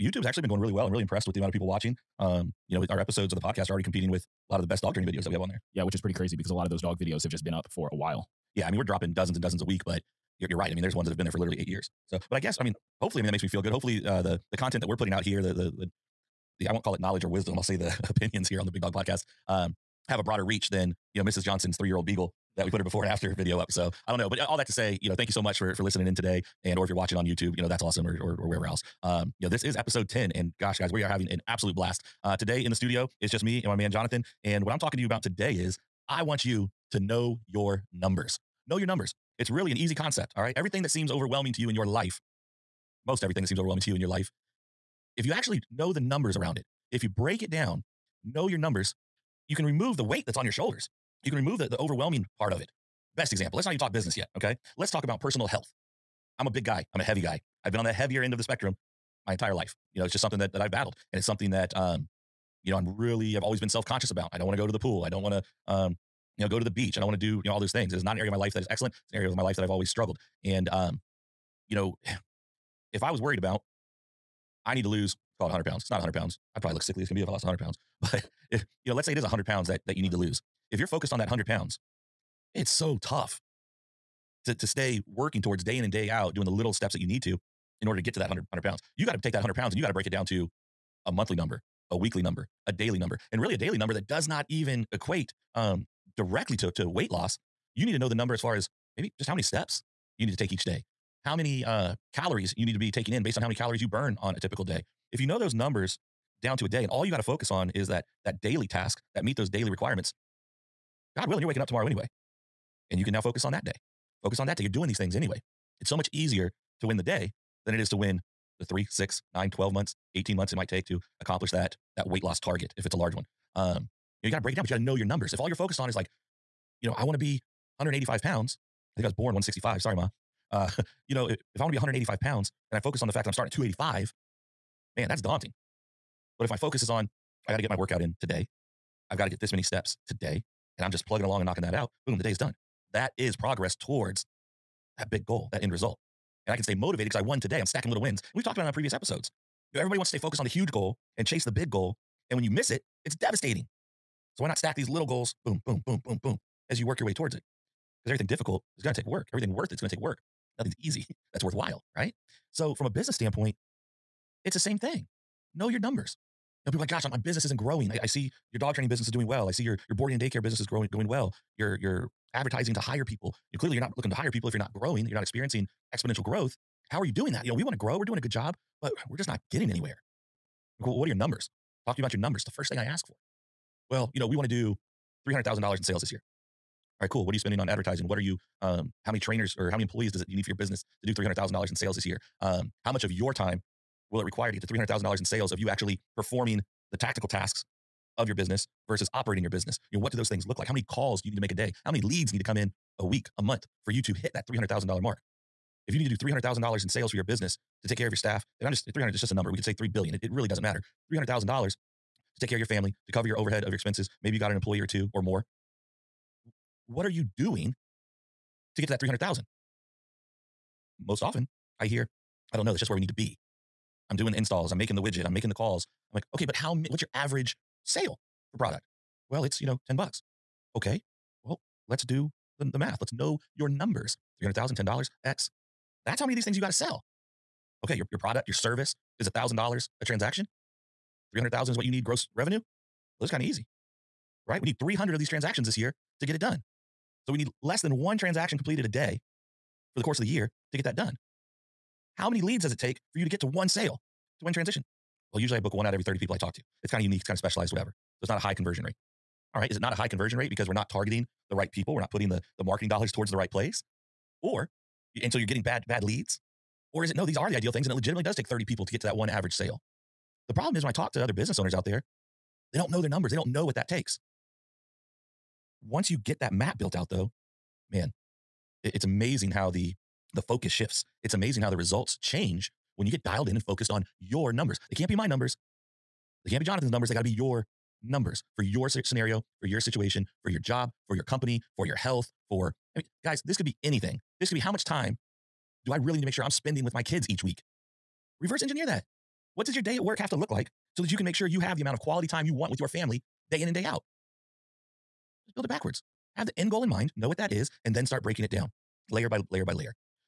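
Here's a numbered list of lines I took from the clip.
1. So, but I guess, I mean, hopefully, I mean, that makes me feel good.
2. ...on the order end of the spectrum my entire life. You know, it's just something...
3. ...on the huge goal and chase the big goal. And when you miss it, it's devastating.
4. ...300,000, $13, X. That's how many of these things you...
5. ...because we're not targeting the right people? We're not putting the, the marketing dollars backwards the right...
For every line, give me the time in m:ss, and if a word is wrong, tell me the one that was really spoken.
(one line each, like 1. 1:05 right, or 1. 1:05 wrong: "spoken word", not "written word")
1. 0:12 right
2. 0:57 wrong: "heavier", not "order"
3. 2:30 right
4. 3:54 wrong: "10", not "13"
5. 4:20 wrong: "towards", not "backwards".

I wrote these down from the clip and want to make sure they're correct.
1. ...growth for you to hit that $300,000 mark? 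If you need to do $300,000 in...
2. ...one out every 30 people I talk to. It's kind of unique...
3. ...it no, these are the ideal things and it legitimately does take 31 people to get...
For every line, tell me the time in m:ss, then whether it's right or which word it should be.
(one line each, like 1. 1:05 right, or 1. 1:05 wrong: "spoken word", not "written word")
1. 3:23 wrong: "month", not "growth"
2. 4:15 right
3. 4:27 wrong: "30", not "31".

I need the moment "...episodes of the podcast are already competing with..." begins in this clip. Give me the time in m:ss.
0:03.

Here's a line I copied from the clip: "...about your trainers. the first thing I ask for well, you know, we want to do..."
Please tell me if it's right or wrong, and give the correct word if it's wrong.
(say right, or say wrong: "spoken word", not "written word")
wrong: "numbers", not "trainers".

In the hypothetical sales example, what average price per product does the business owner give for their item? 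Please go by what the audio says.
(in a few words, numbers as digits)
$10.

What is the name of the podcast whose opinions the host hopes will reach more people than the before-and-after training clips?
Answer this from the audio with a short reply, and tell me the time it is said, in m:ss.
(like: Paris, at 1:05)
Big Dog Podcast, at 0:18.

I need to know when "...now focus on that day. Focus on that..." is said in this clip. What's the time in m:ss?
1:53.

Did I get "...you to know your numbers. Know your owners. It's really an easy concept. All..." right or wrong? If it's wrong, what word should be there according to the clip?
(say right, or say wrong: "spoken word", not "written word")
wrong: "numbers", not "owners".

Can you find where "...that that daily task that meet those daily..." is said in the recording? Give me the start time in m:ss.
1:47.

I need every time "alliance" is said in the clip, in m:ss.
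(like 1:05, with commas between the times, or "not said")
not said.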